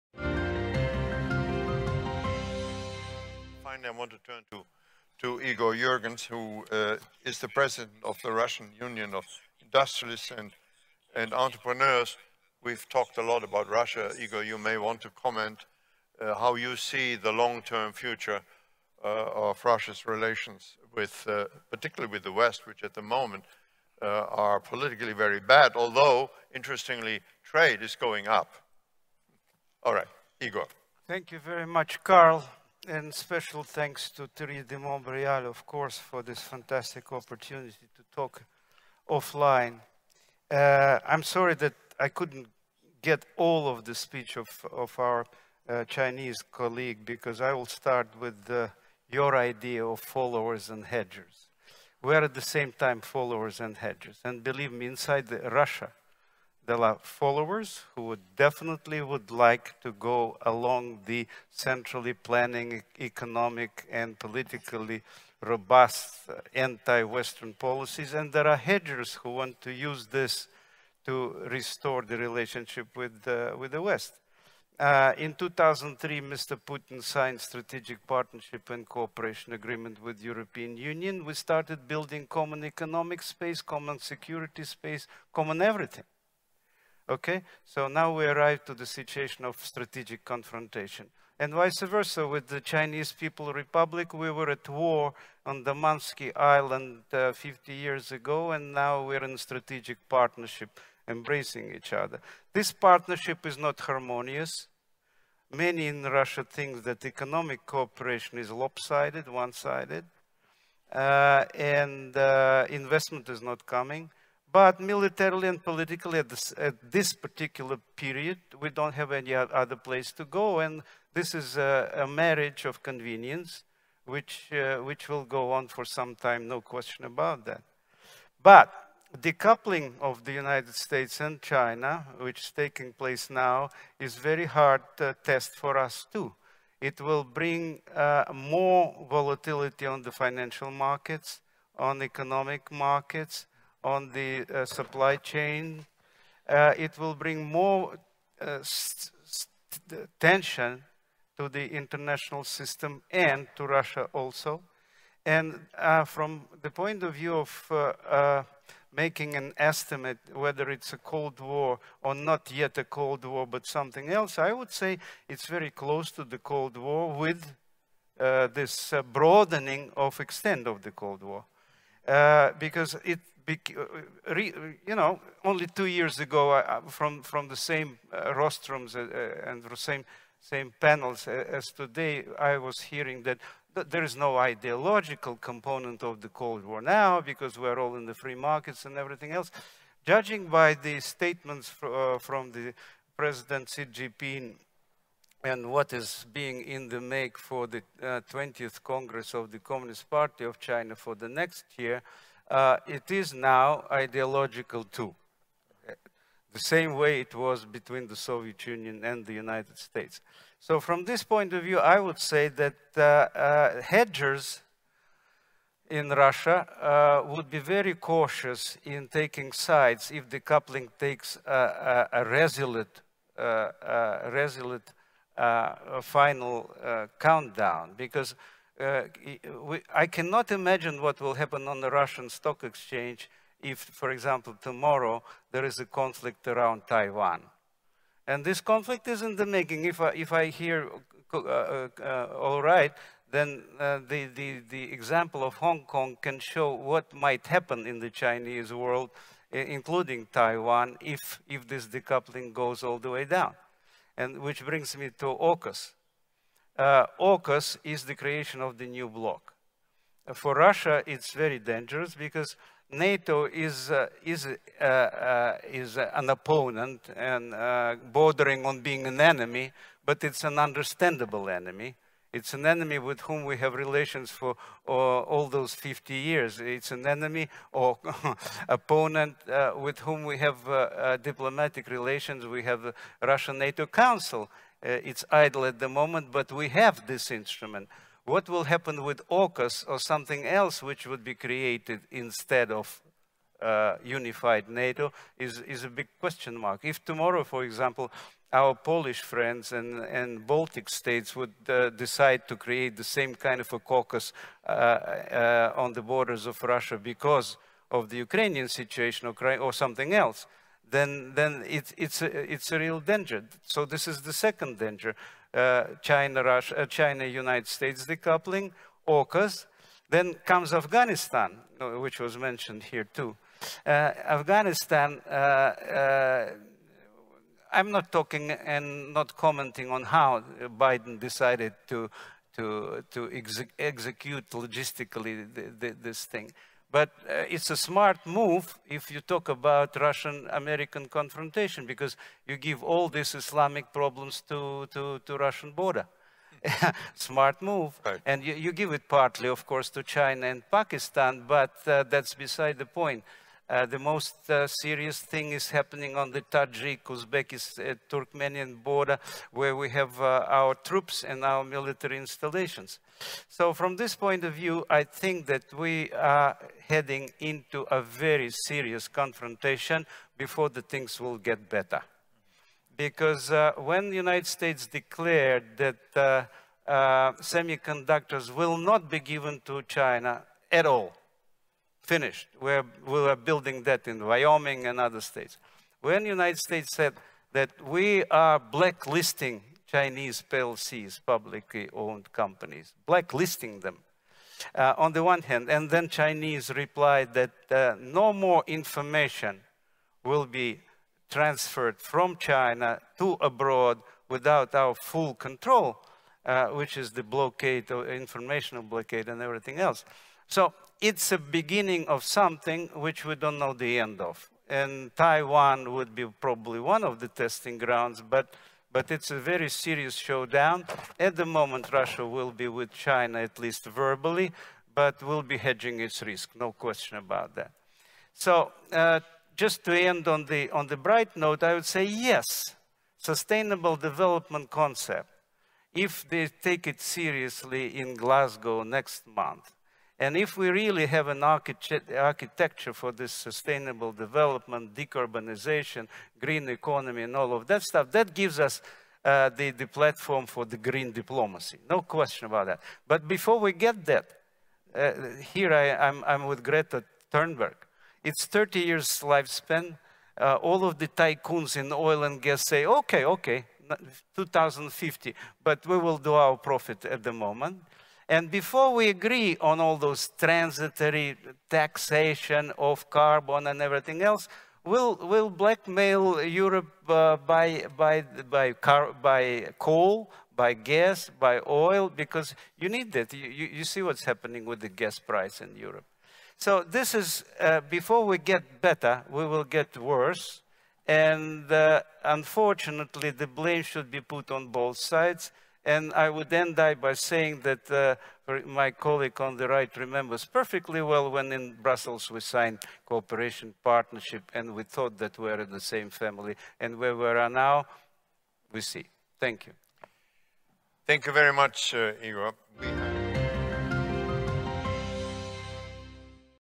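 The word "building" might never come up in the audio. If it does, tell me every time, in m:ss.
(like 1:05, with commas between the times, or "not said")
1:21, 6:23.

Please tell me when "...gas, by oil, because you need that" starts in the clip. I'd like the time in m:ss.
8:00.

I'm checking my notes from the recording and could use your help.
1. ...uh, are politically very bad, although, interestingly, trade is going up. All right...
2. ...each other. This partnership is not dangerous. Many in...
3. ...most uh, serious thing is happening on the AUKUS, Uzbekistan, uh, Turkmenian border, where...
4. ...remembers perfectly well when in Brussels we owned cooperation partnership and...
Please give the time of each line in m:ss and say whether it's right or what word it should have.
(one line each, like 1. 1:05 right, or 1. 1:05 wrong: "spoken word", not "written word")
1. 0:24 right
2. 1:41 wrong: "harmonious", not "dangerous"
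3. 5:53 wrong: "Tajik", not "AUKUS"
4. 8:19 wrong: "signed", not "owned".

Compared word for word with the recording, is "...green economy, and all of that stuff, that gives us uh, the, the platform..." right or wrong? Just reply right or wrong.
right.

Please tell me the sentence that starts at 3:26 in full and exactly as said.
The same way it was between the Soviet Union and the United States.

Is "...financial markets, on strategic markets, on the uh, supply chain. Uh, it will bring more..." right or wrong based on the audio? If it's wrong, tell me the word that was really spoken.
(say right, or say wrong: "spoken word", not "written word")
wrong: "economic", not "strategic".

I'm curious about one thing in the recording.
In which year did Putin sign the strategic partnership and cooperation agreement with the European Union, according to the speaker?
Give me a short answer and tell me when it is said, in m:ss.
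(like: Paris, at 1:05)
2003, at 1:15.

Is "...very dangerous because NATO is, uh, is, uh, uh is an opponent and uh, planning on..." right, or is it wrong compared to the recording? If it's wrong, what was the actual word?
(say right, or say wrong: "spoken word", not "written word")
wrong: "bordering", not "planning".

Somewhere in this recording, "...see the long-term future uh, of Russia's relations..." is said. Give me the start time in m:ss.
0:16.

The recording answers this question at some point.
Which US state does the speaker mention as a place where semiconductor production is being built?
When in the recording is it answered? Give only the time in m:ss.
6:24.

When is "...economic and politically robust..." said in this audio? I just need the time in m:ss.
1:02.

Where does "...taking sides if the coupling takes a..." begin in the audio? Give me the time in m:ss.
3:39.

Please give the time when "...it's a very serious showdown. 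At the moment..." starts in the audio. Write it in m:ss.
6:59.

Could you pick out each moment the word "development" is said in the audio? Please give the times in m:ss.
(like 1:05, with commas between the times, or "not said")
7:13, 7:24.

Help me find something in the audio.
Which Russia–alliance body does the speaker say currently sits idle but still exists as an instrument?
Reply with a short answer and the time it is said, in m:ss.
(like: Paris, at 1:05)
Russian NATO Council, at 4:43.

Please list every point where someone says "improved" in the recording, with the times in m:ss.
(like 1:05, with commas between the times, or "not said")
not said.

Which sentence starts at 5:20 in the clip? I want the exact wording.
Then comes Afghanistan, uh, which was mentioned here too.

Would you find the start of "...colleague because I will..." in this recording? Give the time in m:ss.
0:46.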